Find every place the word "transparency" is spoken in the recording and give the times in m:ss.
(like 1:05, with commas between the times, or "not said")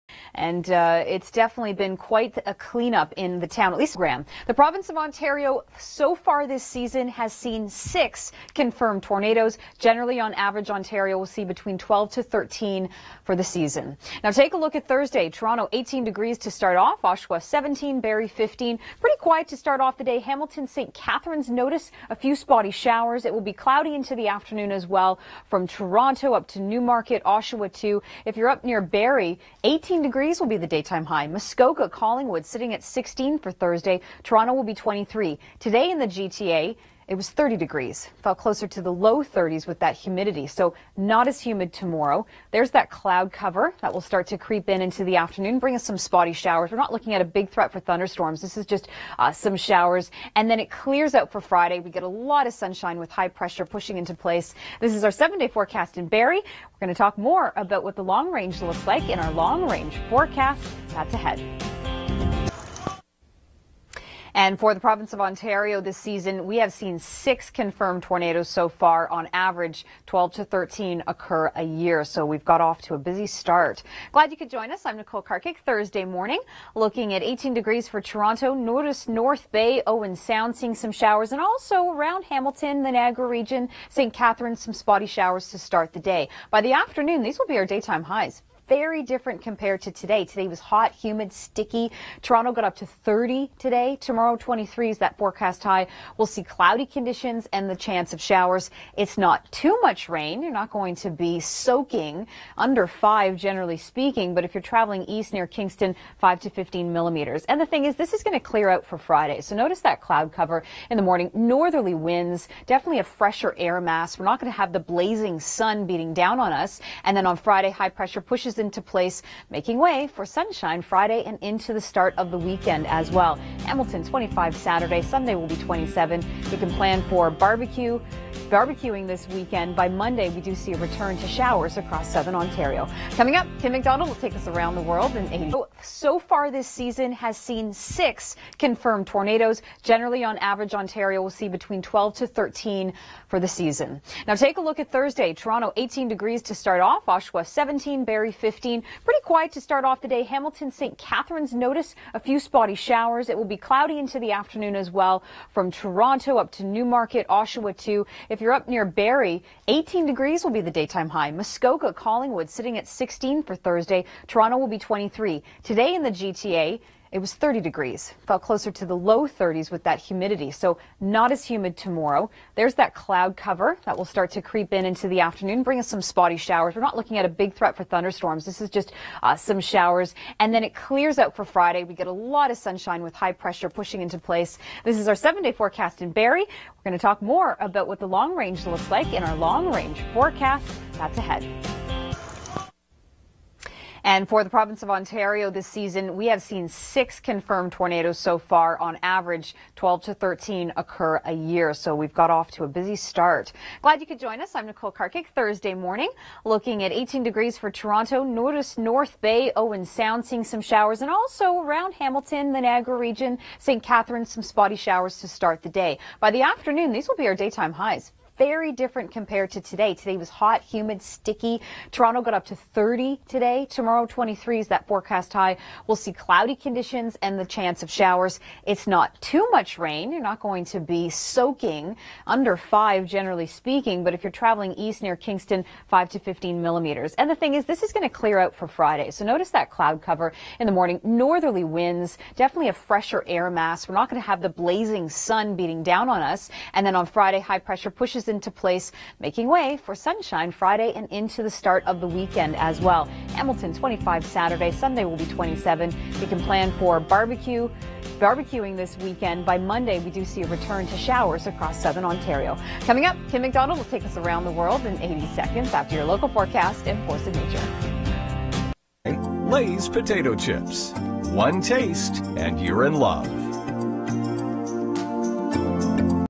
not said.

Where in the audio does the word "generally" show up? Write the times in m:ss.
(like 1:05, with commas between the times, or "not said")
0:09, 1:43, 2:19, 3:53.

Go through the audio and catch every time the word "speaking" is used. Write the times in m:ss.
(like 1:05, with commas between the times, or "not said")
1:43, 3:53.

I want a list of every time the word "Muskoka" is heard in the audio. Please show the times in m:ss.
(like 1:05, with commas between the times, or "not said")
0:31, 2:41.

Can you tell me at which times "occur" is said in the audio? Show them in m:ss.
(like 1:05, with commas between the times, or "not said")
1:11, 3:20.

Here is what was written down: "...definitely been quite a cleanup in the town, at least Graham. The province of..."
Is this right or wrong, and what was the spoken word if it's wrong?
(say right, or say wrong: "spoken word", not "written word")
right.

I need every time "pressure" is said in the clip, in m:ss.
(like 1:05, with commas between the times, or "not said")
0:53, 1:57, 3:03, 4:07.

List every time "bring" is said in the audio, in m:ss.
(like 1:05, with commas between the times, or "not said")
0:45, 2:55.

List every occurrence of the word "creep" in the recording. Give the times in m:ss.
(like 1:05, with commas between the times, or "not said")
0:44, 2:54.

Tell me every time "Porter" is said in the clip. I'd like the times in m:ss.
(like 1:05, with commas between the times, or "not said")
not said.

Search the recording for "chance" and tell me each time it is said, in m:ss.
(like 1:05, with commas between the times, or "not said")
1:37, 3:47.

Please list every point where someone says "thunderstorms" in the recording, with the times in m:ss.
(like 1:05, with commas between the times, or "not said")
0:47, 2:57.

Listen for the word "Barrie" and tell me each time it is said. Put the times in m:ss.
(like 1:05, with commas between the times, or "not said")
0:17, 0:28, 0:56, 2:28, 2:38, 3:06.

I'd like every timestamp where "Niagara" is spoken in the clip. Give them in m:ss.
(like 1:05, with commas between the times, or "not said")
1:22, 3:32.